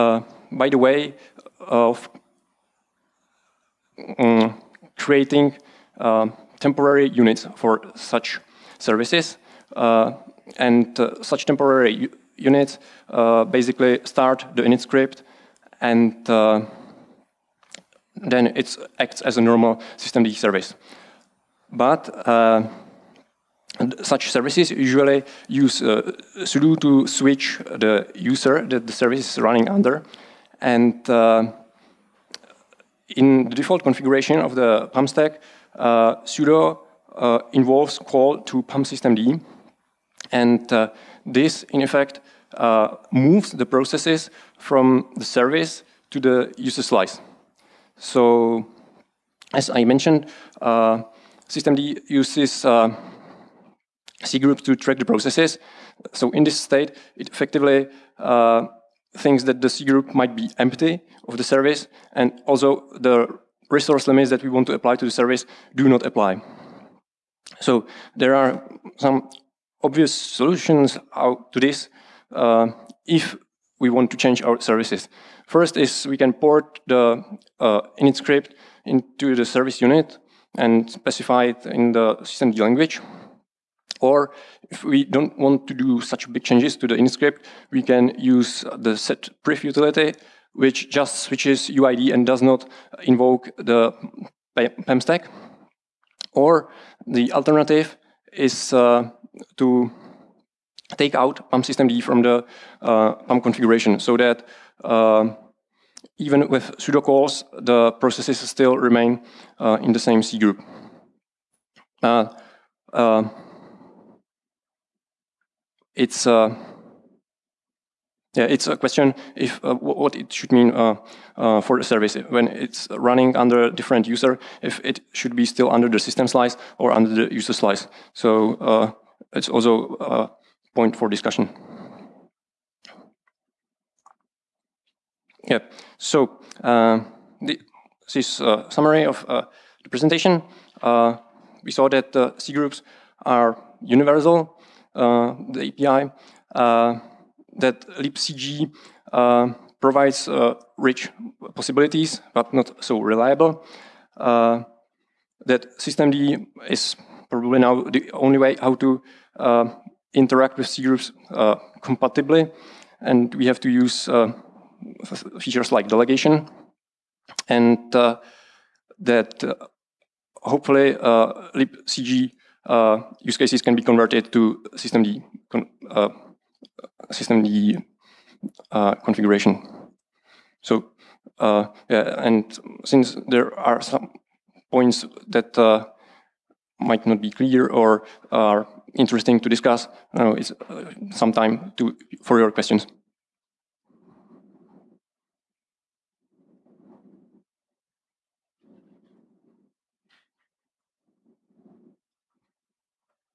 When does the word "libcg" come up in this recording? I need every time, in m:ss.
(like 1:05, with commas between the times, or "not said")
2:27, 2:51.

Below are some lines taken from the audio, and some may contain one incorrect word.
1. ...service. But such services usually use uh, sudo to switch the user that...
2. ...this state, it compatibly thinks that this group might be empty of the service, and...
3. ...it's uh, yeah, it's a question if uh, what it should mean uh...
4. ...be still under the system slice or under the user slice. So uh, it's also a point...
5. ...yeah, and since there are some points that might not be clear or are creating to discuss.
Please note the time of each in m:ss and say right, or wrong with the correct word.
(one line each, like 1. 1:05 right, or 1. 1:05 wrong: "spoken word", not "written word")
1. 0:20 right
2. 0:56 wrong: "effectively", not "compatibly"
3. 1:55 right
4. 2:05 right
5. 3:01 wrong: "interesting", not "creating".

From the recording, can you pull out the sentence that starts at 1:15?
First is we can port the uh, init script into the service unit and specify it in the systemd language.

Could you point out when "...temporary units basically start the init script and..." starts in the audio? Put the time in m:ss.
0:11.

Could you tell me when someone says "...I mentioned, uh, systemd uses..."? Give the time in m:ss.
0:49.